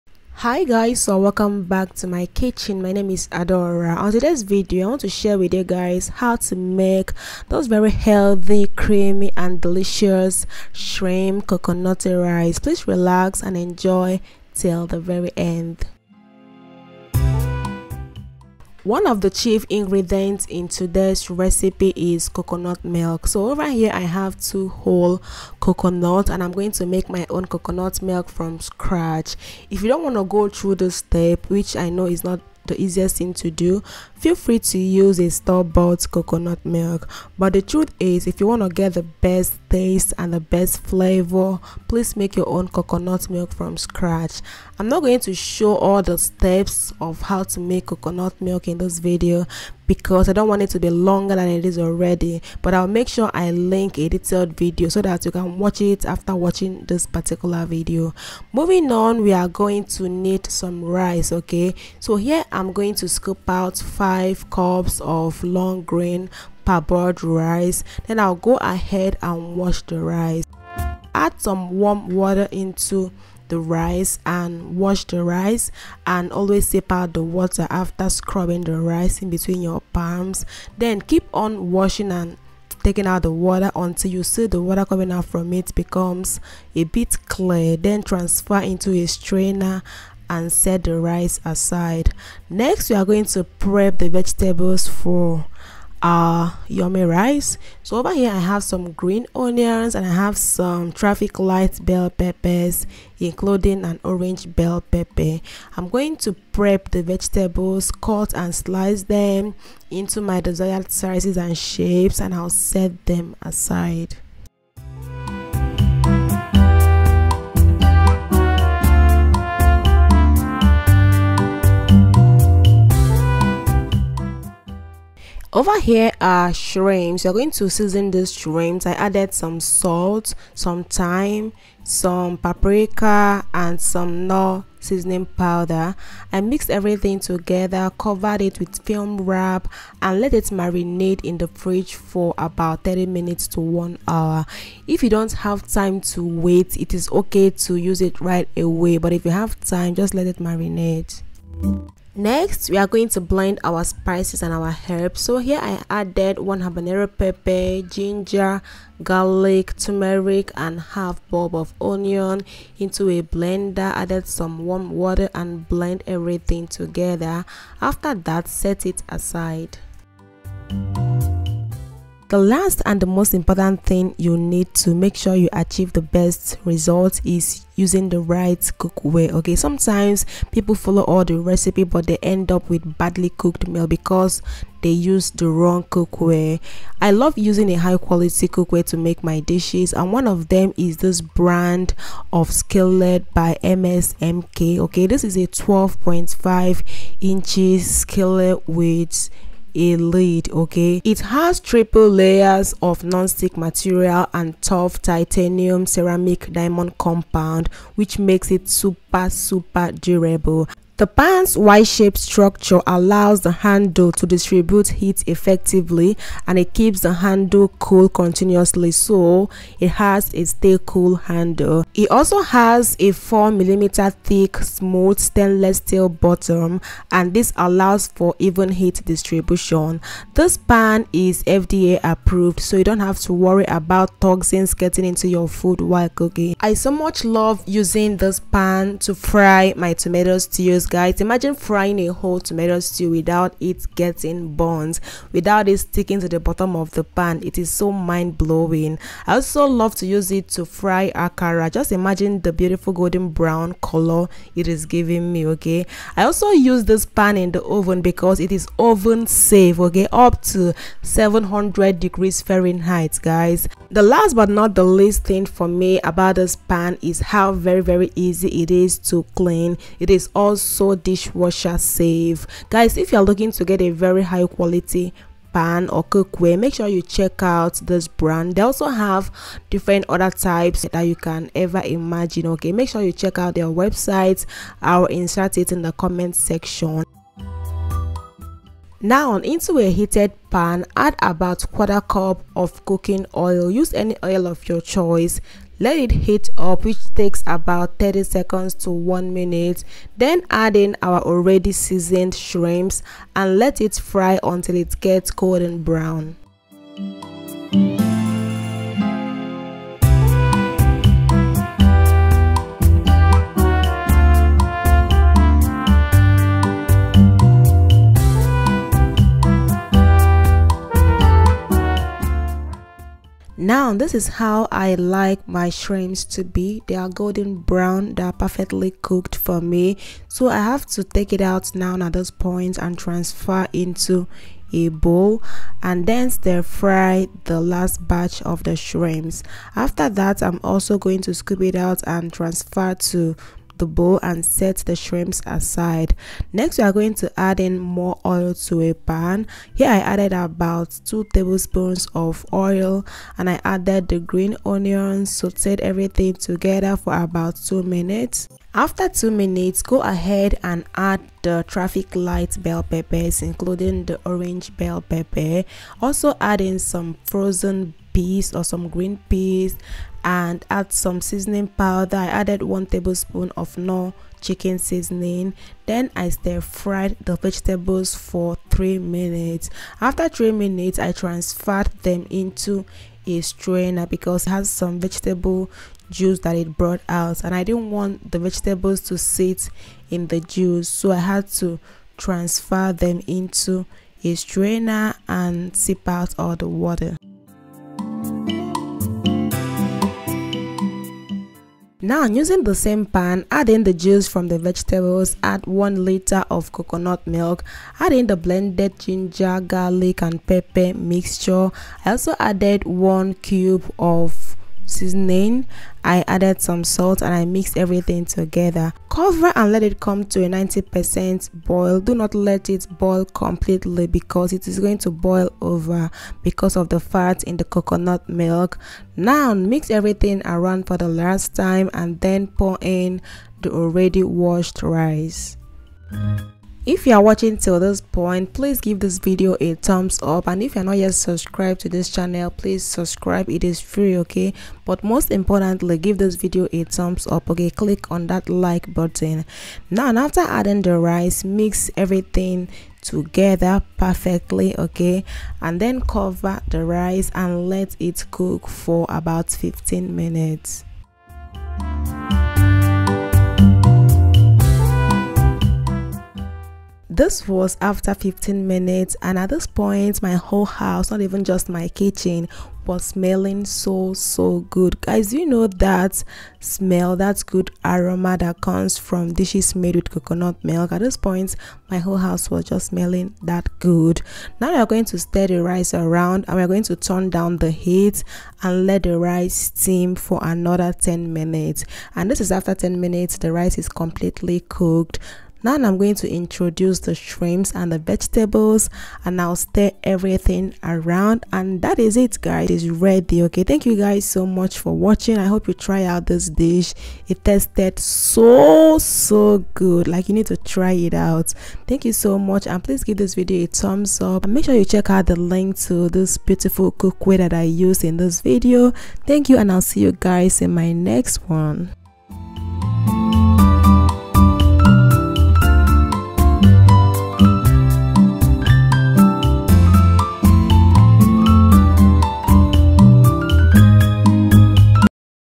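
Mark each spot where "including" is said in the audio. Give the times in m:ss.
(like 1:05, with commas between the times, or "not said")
1:43, 6:03.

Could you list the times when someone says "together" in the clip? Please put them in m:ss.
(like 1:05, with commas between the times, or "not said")
2:17, 2:46, 5:56, 6:58, 7:33.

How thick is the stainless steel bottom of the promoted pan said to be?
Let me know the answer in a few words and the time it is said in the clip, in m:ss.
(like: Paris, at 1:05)
4mm, at 3:43.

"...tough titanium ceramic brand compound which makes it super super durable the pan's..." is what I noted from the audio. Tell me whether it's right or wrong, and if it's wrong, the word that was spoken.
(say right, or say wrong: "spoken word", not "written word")
wrong: "diamond", not "brand".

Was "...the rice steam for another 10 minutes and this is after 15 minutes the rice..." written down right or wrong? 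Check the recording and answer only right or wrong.
wrong.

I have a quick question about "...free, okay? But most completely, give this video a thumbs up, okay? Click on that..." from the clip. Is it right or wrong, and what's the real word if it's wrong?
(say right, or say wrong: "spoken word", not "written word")
wrong: "importantly", not "completely".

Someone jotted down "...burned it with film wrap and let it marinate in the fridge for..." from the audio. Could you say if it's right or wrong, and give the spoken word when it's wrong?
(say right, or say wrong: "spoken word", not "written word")
wrong: "covered", not "burned".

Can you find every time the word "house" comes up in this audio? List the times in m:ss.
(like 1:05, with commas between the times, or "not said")
7:50, 8:02.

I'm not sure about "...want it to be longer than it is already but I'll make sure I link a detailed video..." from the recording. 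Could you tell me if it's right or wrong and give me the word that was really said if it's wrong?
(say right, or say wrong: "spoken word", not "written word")
right.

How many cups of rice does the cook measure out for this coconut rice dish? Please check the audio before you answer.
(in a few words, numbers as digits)
5.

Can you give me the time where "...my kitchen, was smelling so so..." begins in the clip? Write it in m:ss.
7:51.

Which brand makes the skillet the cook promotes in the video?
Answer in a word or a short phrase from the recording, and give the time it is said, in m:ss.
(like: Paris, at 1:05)
MSMK, at 3:13.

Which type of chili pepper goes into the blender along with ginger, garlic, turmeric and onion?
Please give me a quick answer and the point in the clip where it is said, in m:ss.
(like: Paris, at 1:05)
habanero, at 2:36.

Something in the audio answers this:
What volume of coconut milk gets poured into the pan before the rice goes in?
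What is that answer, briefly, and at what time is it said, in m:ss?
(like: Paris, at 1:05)
1 liter, at 6:45.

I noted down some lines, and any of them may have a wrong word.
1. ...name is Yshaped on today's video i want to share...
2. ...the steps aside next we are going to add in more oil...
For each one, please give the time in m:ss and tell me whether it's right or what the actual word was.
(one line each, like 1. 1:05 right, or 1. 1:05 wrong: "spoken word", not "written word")
1. 0:02 wrong: "Adaora", not "Yshaped"
2. 5:44 wrong: "shrimps", not "steps".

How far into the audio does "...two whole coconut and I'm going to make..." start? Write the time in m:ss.
0:24.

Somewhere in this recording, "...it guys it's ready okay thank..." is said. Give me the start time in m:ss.
8:22.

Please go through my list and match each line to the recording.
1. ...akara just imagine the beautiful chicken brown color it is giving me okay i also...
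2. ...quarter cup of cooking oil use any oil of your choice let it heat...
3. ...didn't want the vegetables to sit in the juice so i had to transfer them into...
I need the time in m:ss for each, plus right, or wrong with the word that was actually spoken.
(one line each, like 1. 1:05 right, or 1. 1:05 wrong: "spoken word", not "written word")
1. 4:11 wrong: "golden", not "chicken"
2. 4:51 right
3. 6:27 right.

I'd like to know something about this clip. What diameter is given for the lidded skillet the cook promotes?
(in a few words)
12.5 inches.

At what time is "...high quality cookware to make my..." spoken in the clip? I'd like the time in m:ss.
3:07.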